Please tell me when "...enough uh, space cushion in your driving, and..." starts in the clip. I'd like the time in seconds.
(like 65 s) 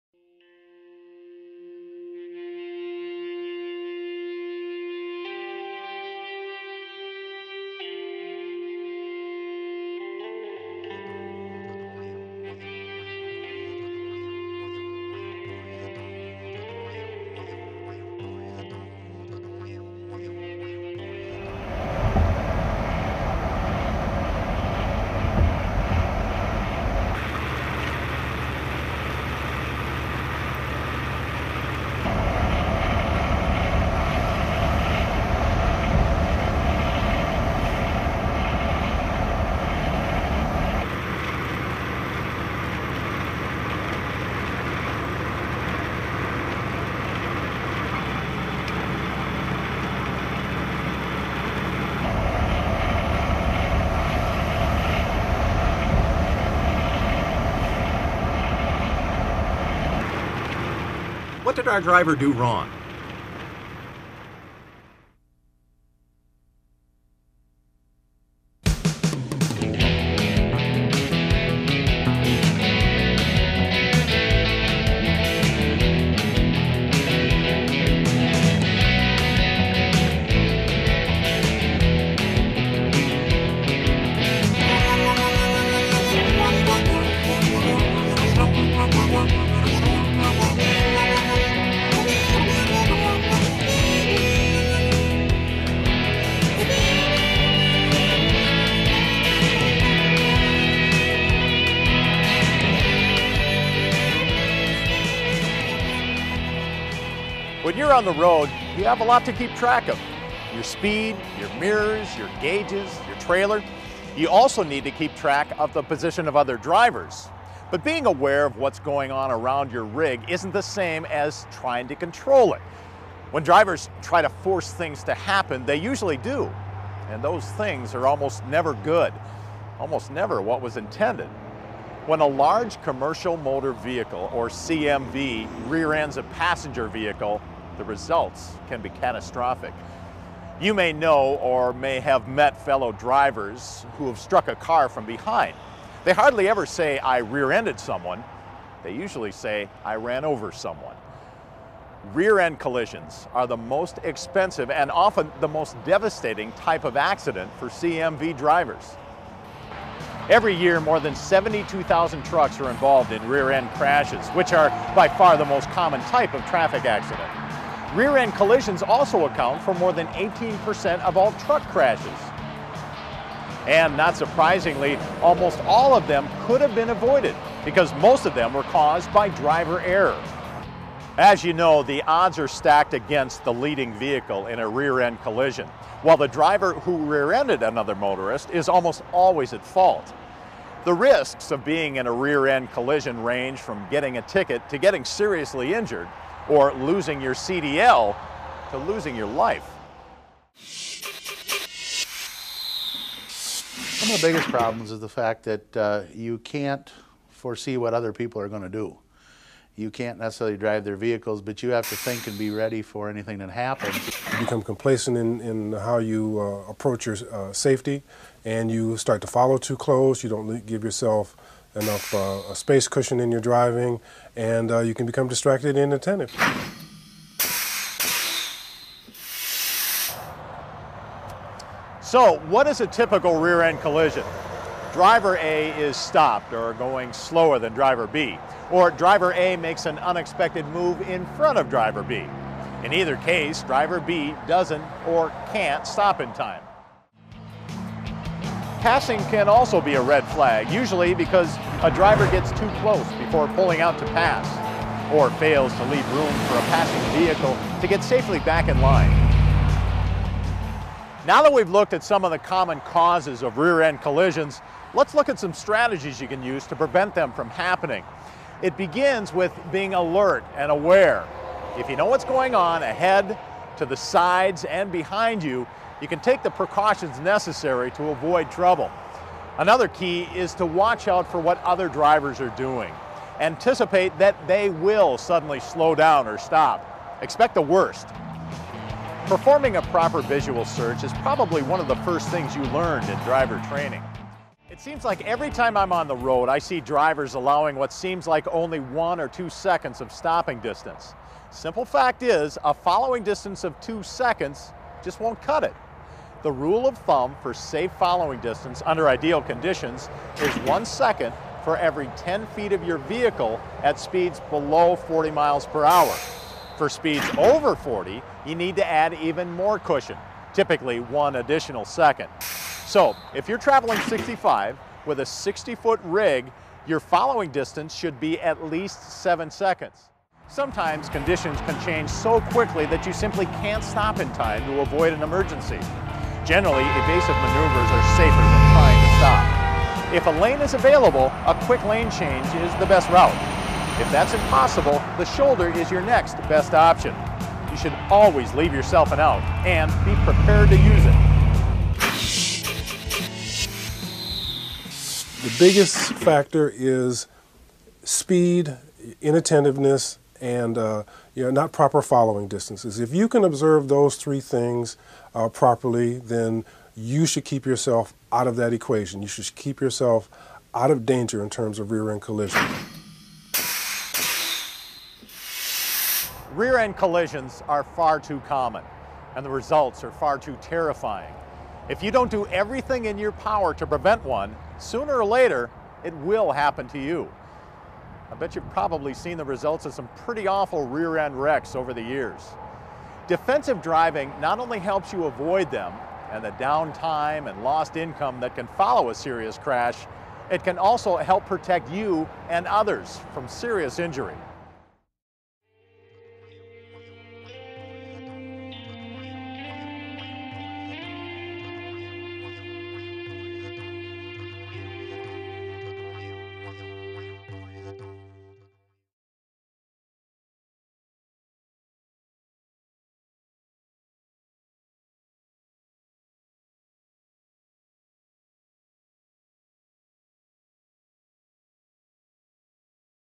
221 s.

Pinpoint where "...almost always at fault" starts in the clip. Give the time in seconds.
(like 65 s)
188 s.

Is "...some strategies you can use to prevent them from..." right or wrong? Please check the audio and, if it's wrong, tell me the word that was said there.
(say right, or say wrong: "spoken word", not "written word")
right.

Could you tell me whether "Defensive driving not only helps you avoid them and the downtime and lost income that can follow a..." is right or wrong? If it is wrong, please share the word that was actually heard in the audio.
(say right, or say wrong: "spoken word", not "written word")
right.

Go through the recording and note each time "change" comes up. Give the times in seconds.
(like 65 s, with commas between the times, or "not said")
331 s, 342 s.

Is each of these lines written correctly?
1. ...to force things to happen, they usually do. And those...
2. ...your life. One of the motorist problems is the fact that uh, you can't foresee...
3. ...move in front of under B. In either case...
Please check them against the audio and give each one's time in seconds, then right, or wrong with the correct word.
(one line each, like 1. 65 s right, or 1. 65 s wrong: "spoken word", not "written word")
1. 124 s right
2. 199 s wrong: "biggest", not "motorist"
3. 240 s wrong: "driver", not "under".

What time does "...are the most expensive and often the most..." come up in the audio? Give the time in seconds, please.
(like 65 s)
153 s.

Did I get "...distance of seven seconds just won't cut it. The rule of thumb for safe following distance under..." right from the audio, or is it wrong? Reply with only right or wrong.
wrong.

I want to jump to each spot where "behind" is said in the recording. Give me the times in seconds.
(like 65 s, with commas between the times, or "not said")
145 s, 274 s.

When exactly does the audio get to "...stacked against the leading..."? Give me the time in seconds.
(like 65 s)
182 s.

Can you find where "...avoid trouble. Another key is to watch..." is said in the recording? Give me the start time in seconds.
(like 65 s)
278 s.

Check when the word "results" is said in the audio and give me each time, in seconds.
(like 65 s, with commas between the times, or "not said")
137 s, 379 s, 389 s.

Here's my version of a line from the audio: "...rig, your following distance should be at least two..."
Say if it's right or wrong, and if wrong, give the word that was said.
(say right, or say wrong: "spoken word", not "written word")
wrong: "seven", not "two".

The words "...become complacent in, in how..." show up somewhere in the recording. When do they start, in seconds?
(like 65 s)
214 s.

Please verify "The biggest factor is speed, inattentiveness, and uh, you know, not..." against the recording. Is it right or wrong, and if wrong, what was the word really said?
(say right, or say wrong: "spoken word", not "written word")
right.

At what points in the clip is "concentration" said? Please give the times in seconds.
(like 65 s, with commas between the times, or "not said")
not said.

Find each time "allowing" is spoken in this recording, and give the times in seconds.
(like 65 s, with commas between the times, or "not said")
297 s.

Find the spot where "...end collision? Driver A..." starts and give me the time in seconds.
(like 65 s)
233 s.